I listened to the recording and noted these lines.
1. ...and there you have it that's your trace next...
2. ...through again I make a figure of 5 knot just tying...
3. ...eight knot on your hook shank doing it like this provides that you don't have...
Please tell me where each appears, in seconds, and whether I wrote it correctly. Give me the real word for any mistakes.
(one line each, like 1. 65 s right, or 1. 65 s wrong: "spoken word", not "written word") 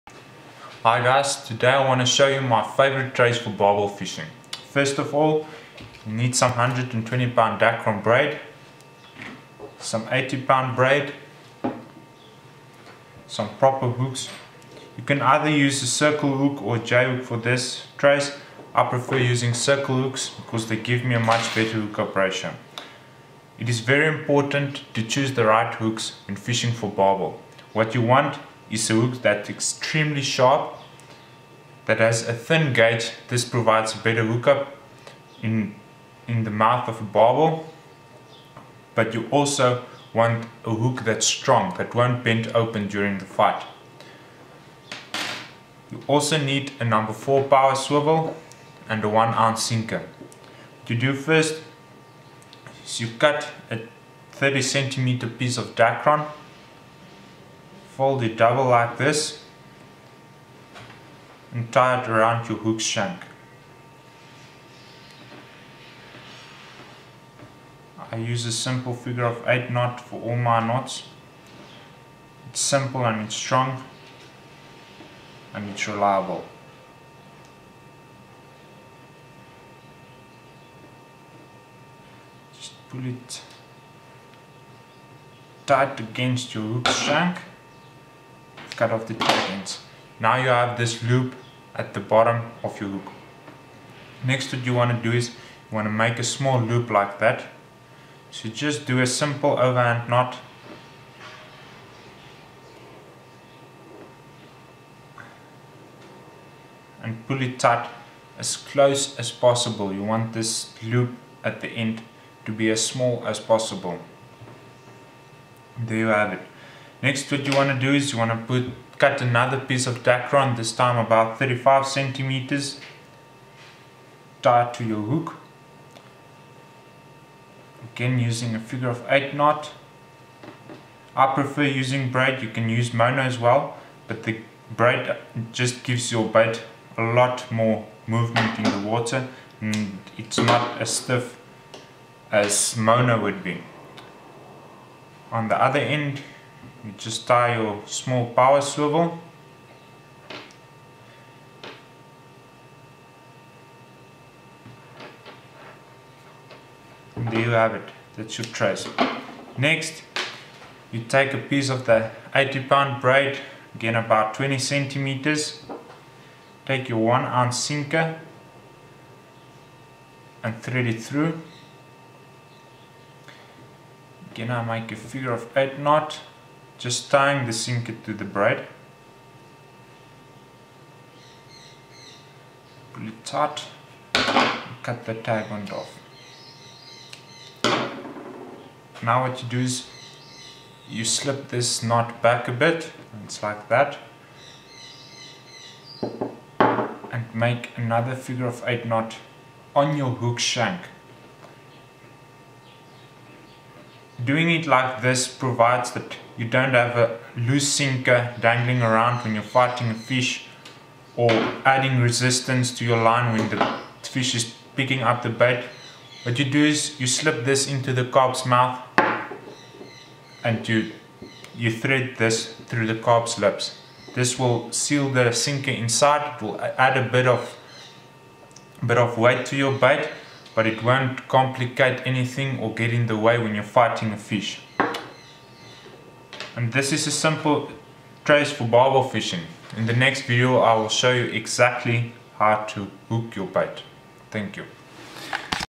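1. 157 s right
2. 170 s wrong: "8", not "5"
3. 198 s right.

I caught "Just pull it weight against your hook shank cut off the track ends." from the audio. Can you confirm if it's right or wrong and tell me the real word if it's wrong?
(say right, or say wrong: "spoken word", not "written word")
wrong: "tight", not "weight".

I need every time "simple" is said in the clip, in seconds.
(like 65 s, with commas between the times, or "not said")
68 s, 72 s, 99 s, 237 s.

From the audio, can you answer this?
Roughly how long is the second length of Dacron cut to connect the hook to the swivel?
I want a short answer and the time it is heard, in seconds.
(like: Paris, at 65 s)
35 centimeters, at 121 s.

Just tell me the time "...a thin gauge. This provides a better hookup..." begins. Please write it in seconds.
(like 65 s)
32 s.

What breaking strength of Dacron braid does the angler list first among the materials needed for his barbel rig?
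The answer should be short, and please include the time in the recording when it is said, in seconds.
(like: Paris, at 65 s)
120 pound, at 6 s.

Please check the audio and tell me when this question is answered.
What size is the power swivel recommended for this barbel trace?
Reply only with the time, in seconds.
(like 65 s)
46 s.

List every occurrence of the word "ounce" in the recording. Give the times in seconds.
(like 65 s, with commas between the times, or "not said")
49 s, 167 s.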